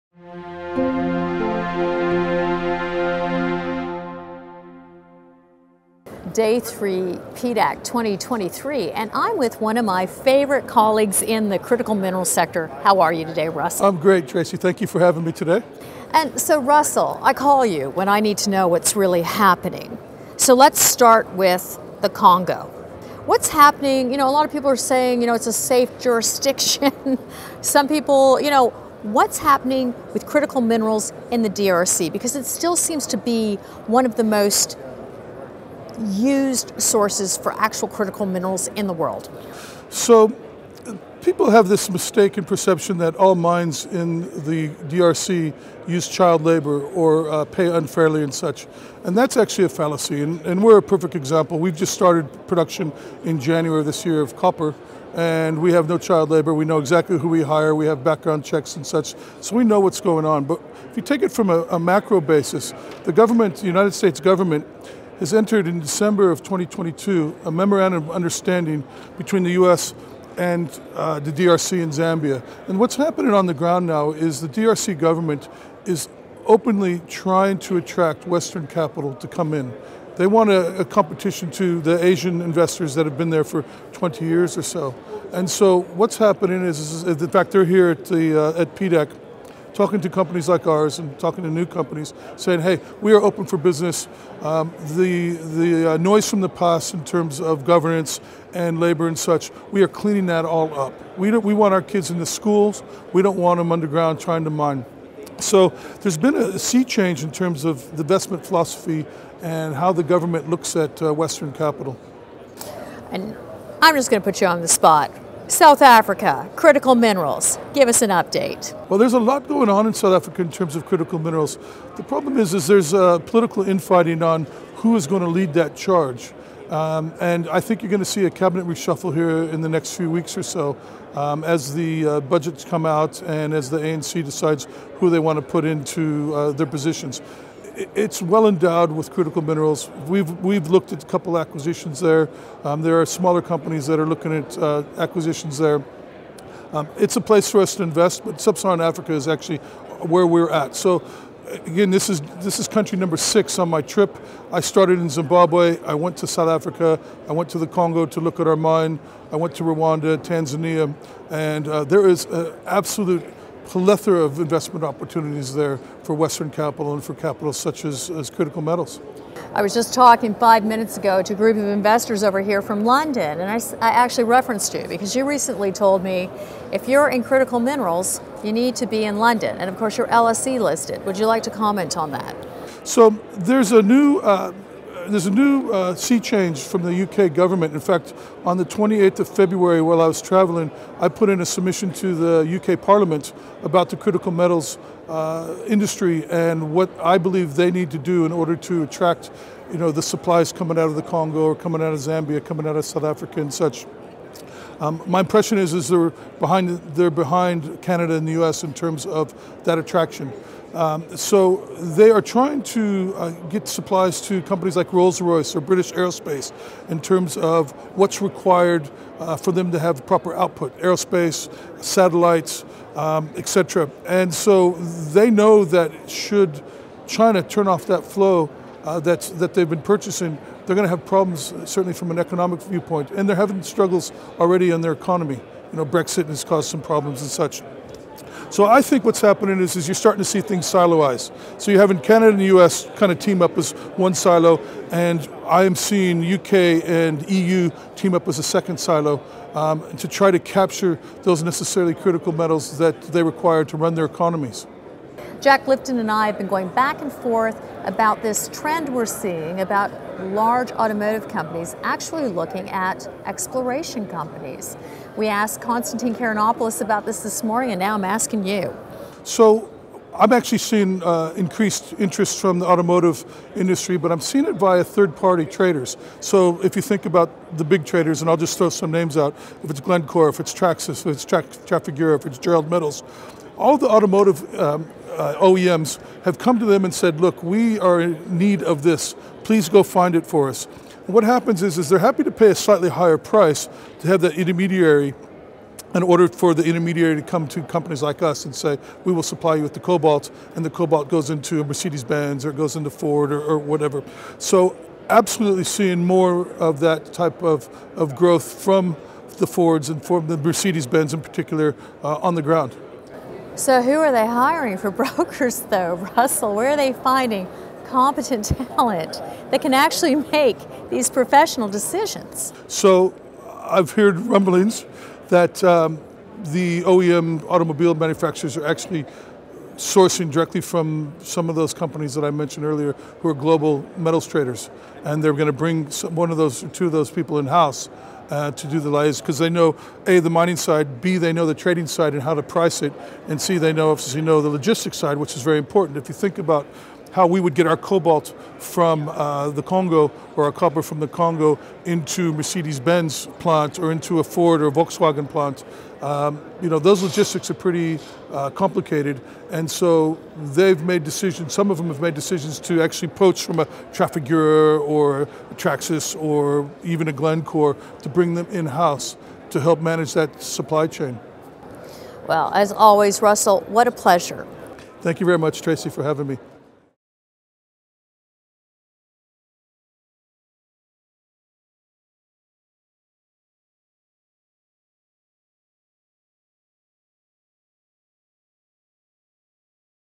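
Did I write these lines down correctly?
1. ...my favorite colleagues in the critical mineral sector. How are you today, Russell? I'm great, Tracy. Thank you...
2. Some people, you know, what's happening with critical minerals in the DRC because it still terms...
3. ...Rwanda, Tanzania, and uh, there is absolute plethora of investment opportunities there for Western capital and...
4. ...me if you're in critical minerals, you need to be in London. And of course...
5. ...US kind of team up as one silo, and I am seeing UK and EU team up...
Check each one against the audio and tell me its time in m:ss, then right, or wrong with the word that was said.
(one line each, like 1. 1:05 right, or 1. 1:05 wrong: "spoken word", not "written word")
1. 0:09 right
2. 0:27 wrong: "seems", not "terms"
3. 2:39 right
4. 2:56 right
5. 4:02 right.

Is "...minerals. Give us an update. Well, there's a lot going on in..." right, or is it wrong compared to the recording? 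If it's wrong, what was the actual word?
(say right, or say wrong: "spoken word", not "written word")
right.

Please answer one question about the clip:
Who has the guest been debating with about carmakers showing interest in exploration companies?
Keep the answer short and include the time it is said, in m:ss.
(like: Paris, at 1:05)
Jack Lifton, at 4:15.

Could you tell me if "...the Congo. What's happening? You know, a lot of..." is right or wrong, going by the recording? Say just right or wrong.
right.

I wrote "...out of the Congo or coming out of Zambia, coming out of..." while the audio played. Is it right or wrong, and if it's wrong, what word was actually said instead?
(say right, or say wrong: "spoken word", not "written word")
right.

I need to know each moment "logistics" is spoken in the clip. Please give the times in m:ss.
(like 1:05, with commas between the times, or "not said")
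5:44, 5:57.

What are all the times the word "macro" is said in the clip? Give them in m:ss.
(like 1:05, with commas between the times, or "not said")
1:01.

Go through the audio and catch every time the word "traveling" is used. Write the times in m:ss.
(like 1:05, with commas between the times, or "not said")
3:10.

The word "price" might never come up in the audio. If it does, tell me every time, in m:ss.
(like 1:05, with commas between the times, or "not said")
4:53, 5:42.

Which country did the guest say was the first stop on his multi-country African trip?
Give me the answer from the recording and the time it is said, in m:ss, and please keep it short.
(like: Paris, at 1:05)
Zimbabwe, at 2:35.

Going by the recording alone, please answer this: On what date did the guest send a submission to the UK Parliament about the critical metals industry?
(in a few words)
28 February.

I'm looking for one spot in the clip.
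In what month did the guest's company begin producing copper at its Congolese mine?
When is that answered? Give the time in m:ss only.
0:53.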